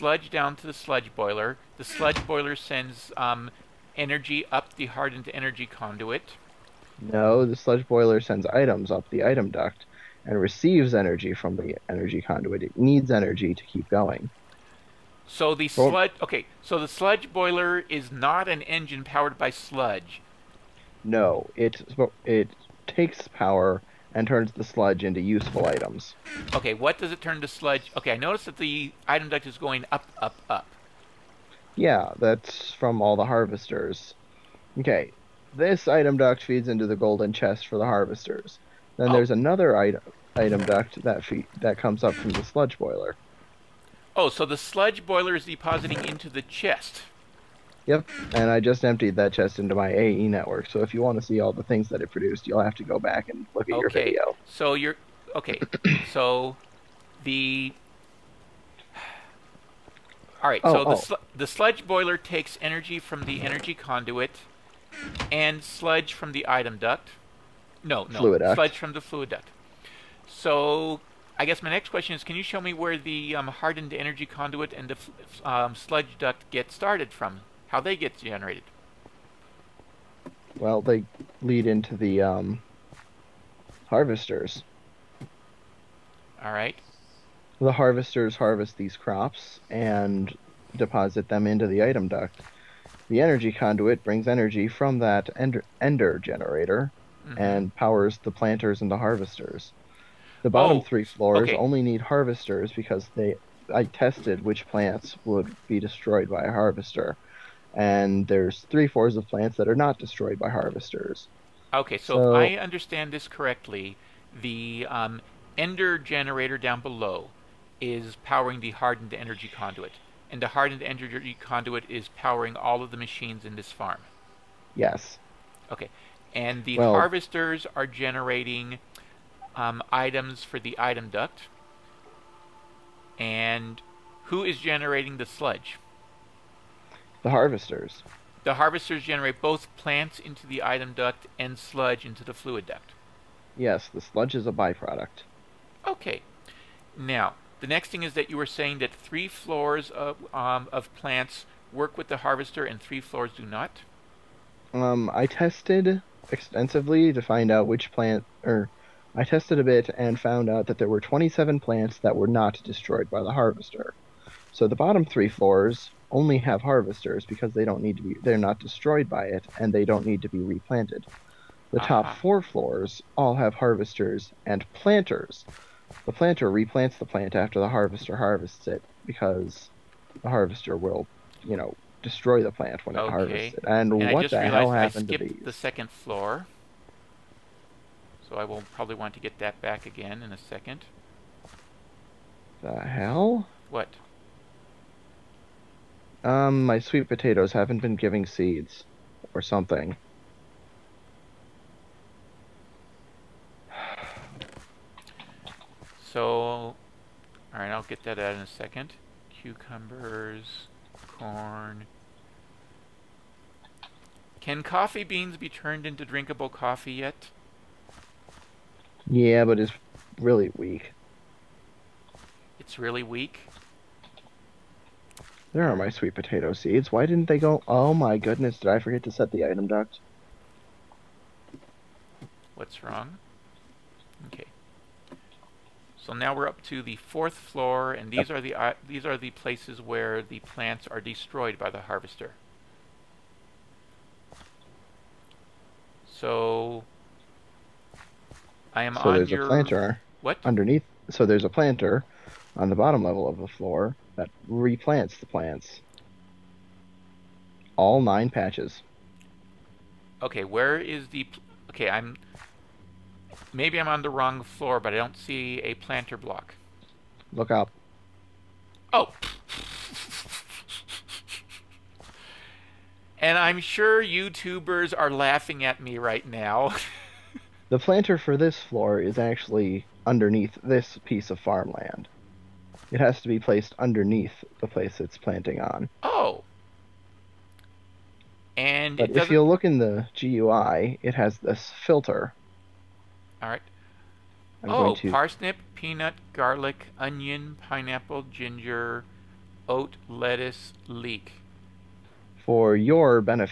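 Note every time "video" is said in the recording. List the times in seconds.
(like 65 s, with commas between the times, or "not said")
53 s.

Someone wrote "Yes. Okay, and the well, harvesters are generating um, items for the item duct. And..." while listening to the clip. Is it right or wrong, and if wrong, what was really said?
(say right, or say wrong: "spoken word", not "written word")
right.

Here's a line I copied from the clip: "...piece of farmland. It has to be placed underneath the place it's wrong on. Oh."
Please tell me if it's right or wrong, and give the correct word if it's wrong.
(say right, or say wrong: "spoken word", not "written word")
wrong: "planting", not "wrong".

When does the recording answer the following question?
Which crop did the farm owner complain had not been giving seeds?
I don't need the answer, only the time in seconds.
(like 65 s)
196 s.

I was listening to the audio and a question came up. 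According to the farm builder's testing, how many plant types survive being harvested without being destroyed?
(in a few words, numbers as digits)
27.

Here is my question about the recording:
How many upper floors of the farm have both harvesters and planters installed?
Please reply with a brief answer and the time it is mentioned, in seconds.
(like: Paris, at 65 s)
4, at 172 s.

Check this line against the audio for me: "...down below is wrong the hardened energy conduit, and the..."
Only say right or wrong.
wrong.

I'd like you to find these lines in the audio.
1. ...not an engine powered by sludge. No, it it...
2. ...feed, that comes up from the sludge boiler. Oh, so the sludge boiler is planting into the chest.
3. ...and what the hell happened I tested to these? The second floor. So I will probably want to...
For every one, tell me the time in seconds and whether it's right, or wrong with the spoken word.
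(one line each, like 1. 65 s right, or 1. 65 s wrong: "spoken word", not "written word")
1. 18 s right
2. 41 s wrong: "depositing", not "planting"
3. 183 s wrong: "skipped", not "tested".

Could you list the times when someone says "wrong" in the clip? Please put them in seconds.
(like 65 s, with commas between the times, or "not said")
232 s, 264 s.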